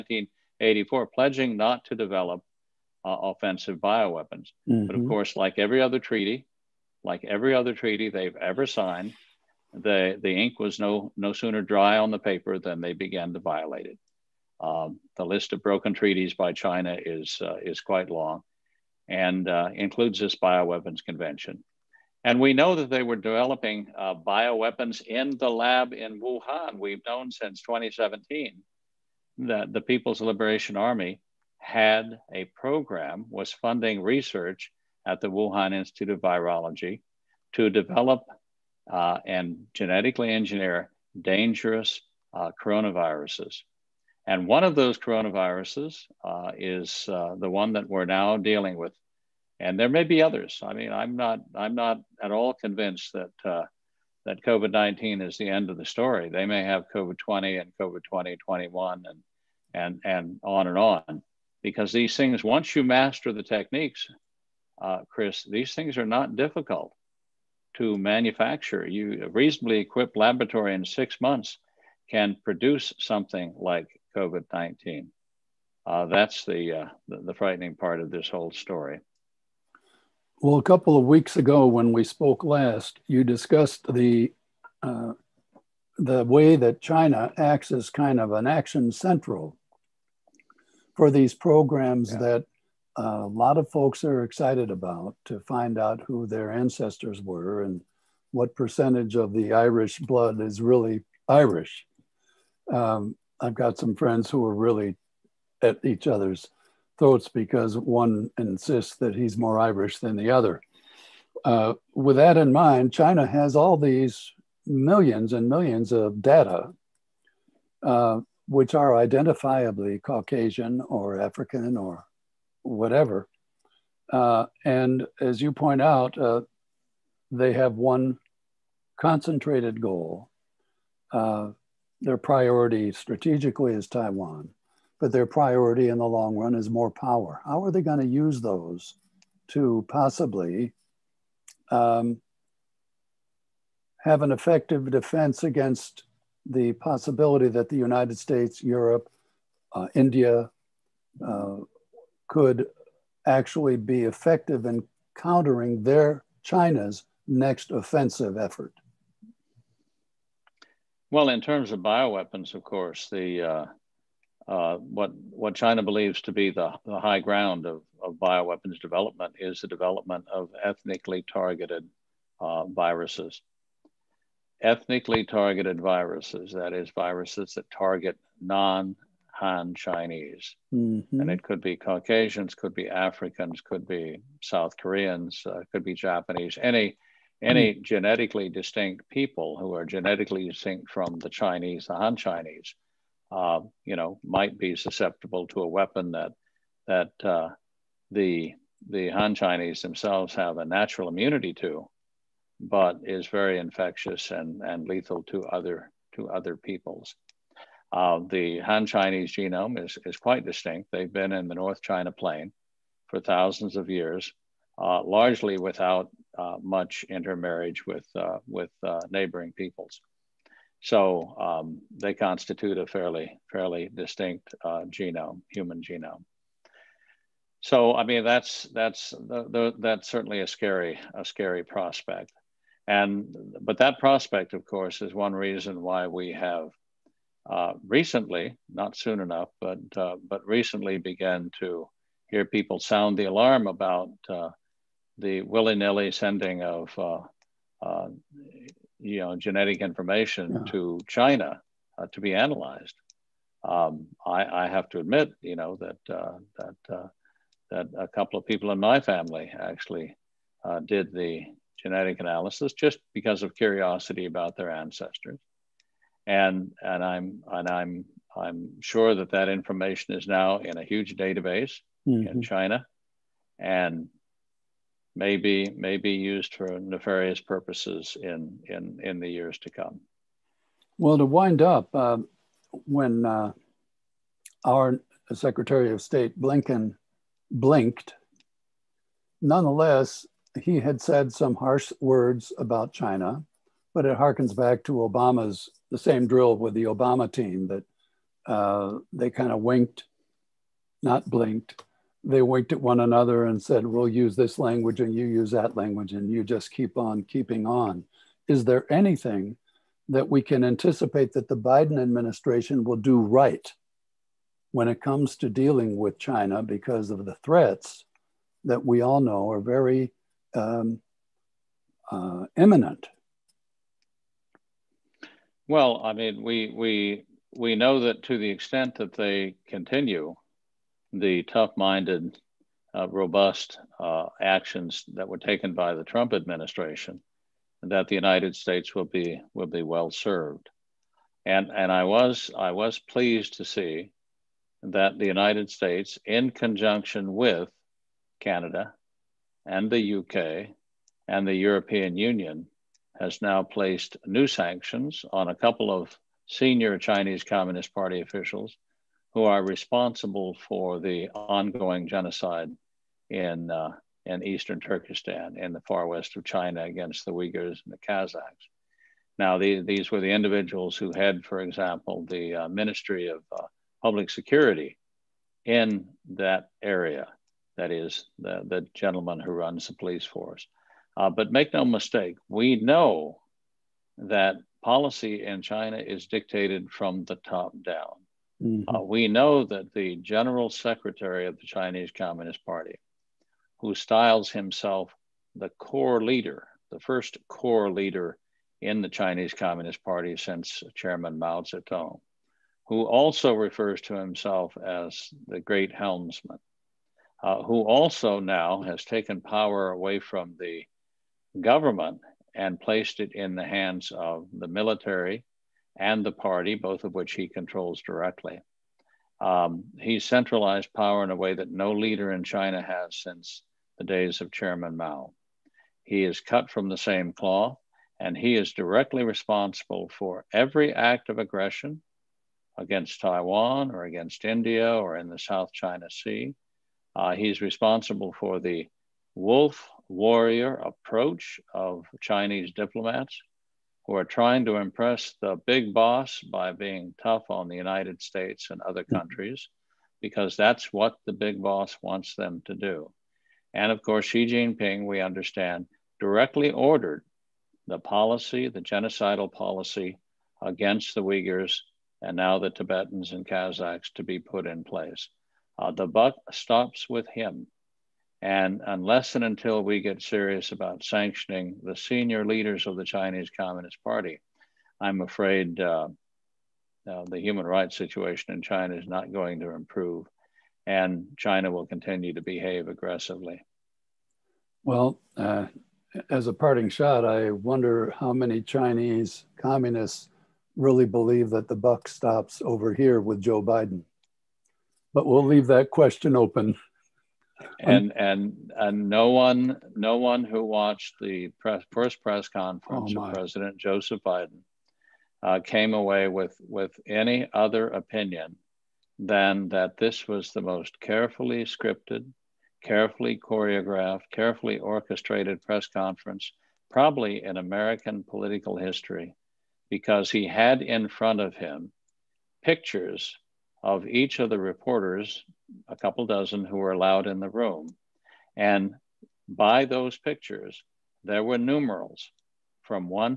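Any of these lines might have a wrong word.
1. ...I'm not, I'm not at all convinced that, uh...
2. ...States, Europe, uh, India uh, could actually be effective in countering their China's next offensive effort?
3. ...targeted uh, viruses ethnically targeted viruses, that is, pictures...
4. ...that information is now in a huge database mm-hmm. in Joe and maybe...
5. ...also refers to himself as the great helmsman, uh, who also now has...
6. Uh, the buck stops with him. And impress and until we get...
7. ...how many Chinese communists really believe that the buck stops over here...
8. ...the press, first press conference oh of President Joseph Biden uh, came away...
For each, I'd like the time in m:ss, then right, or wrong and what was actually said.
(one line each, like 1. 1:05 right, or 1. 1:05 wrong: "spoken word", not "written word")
1. 0:50 right
2. 2:28 right
3. 2:51 wrong: "viruses", not "pictures"
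4. 4:29 wrong: "China", not "Joe"
5. 6:43 right
6. 7:45 wrong: "unless", not "impress"
7. 8:08 right
8. 8:21 right.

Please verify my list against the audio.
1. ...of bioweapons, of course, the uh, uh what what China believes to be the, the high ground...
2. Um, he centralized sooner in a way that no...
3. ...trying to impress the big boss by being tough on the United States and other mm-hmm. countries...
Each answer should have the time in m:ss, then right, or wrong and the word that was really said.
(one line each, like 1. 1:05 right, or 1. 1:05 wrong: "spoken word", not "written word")
1. 2:41 right
2. 6:59 wrong: "power", not "sooner"
3. 7:24 right.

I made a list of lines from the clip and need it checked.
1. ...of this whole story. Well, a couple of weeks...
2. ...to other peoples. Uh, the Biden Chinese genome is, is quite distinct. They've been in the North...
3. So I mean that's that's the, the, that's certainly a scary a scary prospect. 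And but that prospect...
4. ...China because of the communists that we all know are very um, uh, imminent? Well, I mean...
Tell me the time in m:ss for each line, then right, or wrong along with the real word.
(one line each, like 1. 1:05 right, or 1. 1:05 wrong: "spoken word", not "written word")
1. 1:17 right
2. 3:26 wrong: "Han", not "Biden"
3. 3:47 right
4. 5:16 wrong: "threats", not "communists".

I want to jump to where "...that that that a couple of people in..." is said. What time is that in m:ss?
4:15.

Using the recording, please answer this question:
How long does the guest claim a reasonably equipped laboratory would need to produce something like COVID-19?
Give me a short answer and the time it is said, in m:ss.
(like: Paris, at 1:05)
6 months, at 1:10.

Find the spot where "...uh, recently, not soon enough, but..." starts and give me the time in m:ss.
3:57.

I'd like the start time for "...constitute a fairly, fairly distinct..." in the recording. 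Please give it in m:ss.
3:42.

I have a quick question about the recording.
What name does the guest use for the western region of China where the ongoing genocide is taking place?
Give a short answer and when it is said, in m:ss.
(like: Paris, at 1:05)
Eastern Turkestan, at 6:04.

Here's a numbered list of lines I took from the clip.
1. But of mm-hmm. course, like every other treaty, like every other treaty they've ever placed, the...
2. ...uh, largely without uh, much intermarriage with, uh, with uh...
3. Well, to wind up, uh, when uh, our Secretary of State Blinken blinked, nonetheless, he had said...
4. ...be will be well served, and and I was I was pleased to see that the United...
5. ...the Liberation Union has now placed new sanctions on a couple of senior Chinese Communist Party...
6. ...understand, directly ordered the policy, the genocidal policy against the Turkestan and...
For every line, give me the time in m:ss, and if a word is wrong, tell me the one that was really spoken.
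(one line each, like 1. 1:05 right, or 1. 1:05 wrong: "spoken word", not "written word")
1. 0:04 wrong: "signed", not "placed"
2. 3:34 right
3. 4:40 right
4. 5:39 right
5. 5:51 wrong: "European", not "Liberation"
6. 7:35 wrong: "Uyghurs", not "Turkestan".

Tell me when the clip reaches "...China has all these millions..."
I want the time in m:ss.
1:52.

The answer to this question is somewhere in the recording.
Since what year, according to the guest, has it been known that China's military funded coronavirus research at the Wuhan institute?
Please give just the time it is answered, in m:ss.
0:27.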